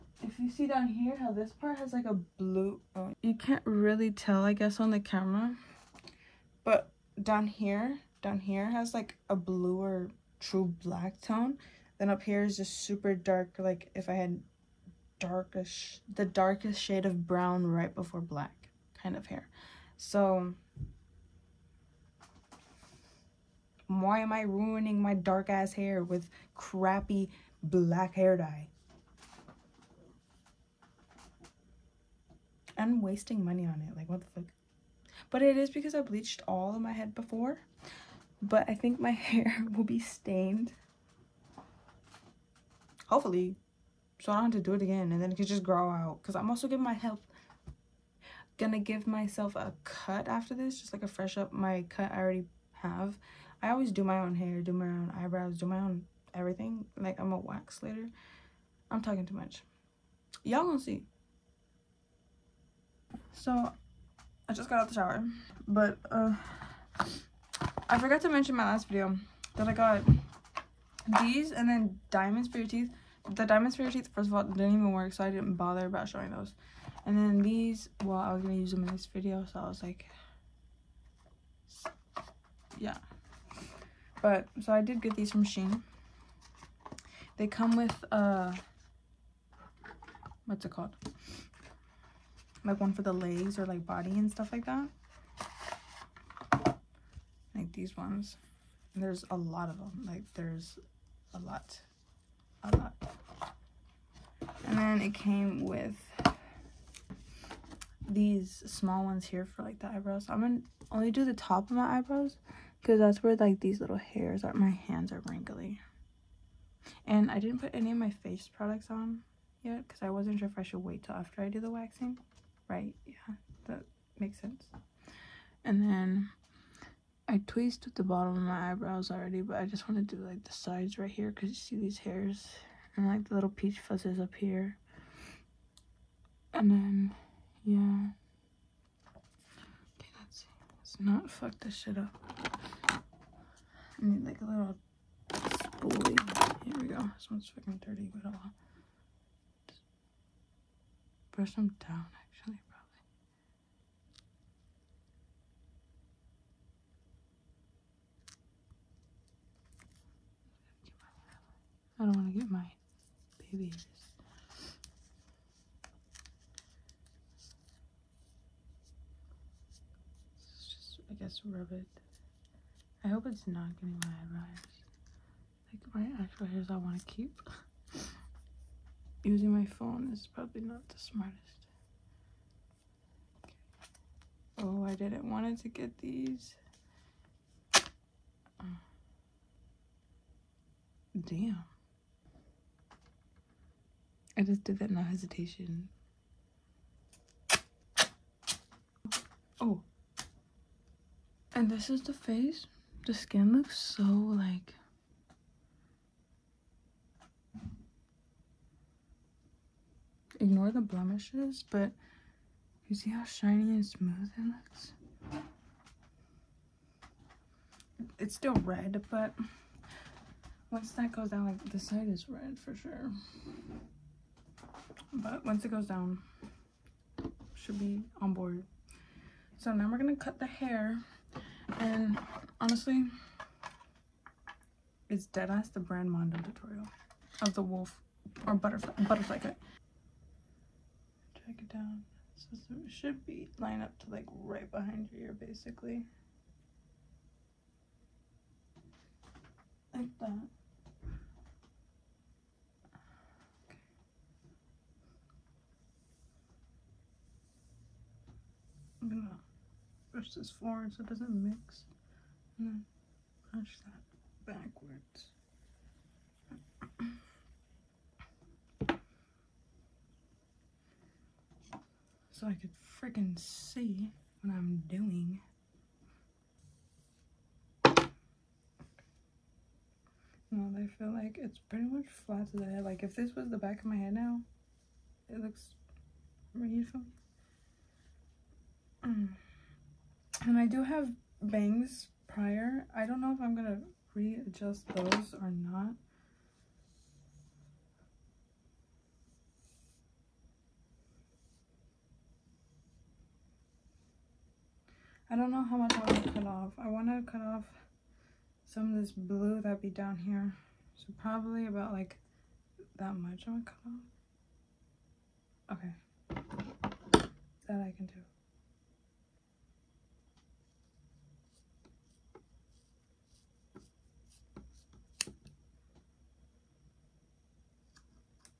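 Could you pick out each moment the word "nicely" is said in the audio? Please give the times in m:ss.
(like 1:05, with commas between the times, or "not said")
not said.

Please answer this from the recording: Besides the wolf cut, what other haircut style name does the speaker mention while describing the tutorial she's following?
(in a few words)
butterfly cut.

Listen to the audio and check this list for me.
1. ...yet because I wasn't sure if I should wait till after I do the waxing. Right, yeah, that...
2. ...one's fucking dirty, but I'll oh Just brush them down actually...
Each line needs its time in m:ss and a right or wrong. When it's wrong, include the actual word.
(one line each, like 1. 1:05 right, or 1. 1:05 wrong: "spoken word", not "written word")
1. 1:59 right
2. 2:27 right.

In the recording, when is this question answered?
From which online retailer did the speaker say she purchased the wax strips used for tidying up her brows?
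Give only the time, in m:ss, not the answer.
1:25.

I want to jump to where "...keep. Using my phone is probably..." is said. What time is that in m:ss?
2:57.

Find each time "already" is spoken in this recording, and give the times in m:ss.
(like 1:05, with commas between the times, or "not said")
0:52, 2:09.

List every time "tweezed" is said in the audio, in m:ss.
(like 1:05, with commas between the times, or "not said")
2:07.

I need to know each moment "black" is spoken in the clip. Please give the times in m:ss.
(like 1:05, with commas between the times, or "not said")
0:10, 0:18, 0:27.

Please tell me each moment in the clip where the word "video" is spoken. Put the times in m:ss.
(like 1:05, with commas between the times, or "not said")
1:08, 1:19.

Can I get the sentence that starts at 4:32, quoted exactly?
so I could freaking see what I'm doing.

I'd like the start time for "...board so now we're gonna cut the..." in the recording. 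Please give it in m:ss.
3:48.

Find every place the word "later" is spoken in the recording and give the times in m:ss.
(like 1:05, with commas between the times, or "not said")
0:57.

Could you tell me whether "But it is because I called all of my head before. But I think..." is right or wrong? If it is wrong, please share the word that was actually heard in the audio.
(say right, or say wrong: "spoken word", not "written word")
wrong: "bleached", not "called".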